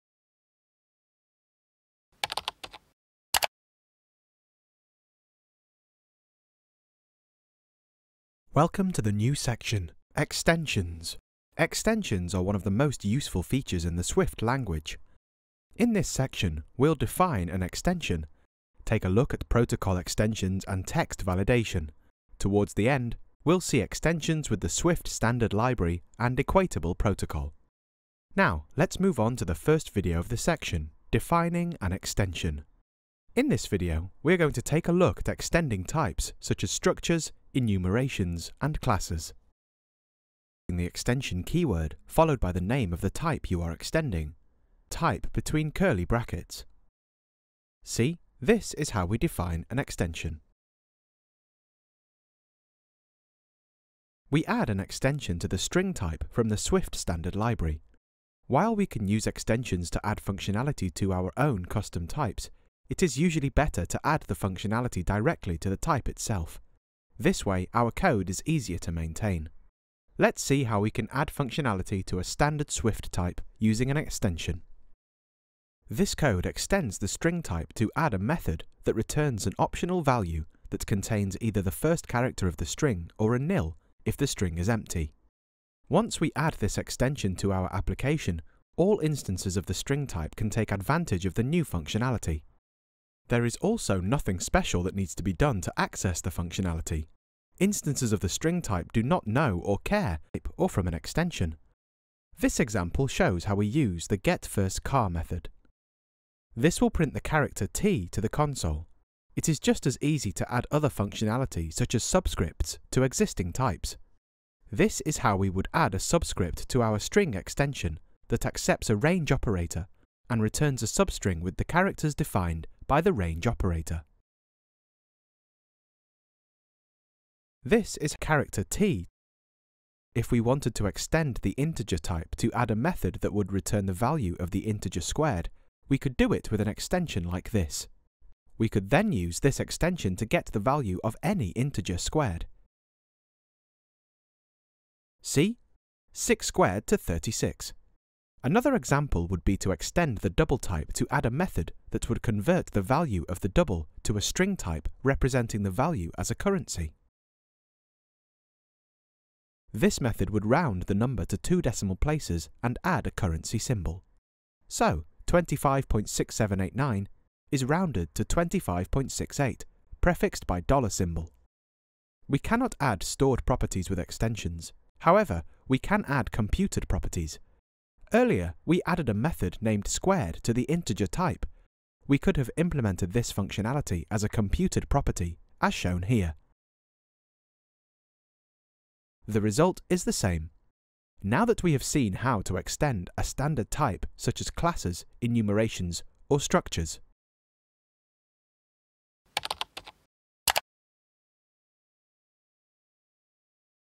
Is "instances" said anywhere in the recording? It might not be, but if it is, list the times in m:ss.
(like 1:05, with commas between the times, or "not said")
1:28, 1:37.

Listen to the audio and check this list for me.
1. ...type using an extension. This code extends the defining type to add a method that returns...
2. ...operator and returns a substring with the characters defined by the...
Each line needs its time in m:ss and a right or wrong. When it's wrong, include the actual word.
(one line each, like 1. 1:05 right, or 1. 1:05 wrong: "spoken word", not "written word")
1. 1:13 wrong: "string", not "defining"
2. 1:59 right.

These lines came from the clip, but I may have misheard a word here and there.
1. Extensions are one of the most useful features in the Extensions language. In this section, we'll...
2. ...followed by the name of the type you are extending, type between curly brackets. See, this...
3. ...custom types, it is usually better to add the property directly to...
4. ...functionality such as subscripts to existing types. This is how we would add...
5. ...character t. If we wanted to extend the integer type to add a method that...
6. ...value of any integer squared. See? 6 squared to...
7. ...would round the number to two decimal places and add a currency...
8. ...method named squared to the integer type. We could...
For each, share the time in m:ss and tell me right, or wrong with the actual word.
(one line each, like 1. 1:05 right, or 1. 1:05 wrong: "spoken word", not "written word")
1. 0:11 wrong: "Swift", not "Extensions"
2. 0:42 right
3. 1:01 wrong: "functionality", not "property"
4. 1:50 right
5. 2:08 right
6. 2:20 right
7. 2:40 right
8. 2:59 right.